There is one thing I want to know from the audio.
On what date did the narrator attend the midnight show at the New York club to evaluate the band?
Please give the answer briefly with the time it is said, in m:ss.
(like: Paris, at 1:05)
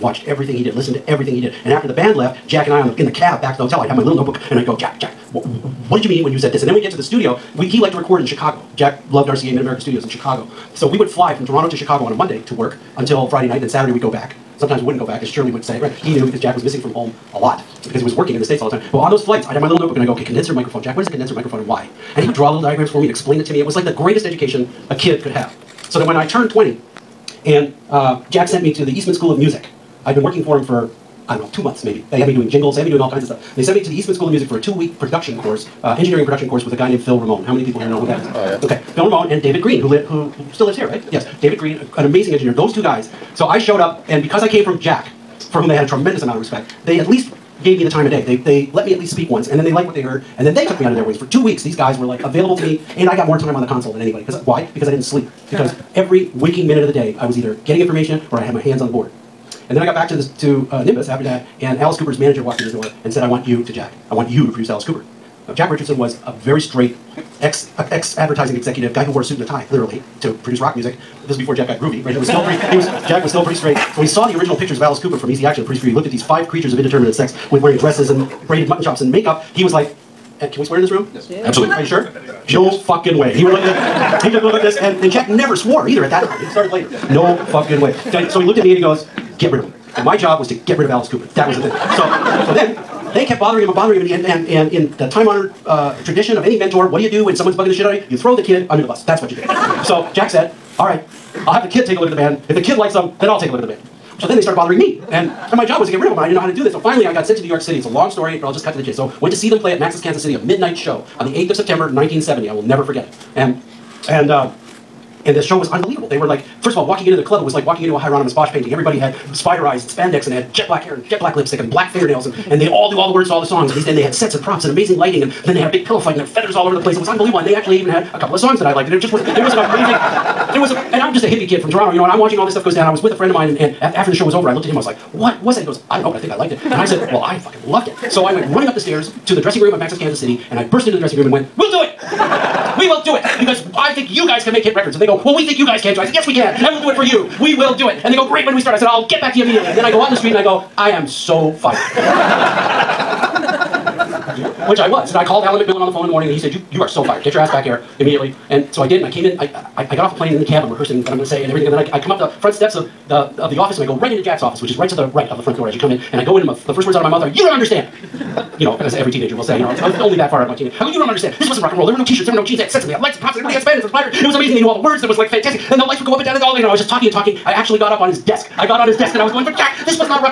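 8 September 1970, at 1:51.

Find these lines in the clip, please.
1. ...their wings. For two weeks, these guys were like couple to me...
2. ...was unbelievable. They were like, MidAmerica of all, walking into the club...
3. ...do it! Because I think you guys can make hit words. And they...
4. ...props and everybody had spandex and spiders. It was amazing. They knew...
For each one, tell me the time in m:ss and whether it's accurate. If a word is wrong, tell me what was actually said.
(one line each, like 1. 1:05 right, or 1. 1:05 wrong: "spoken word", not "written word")
1. 0:50 wrong: "available", not "couple"
2. 1:55 wrong: "First", not "MidAmerica"
3. 2:23 wrong: "records", not "words"
4. 2:53 right.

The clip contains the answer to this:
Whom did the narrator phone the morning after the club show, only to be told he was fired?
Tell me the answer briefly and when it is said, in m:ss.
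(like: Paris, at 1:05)
Alan McMillan, at 2:35.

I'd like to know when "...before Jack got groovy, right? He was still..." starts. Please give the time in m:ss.
1:11.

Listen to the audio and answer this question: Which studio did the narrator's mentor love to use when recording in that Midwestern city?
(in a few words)
RCA Mid-America Studios.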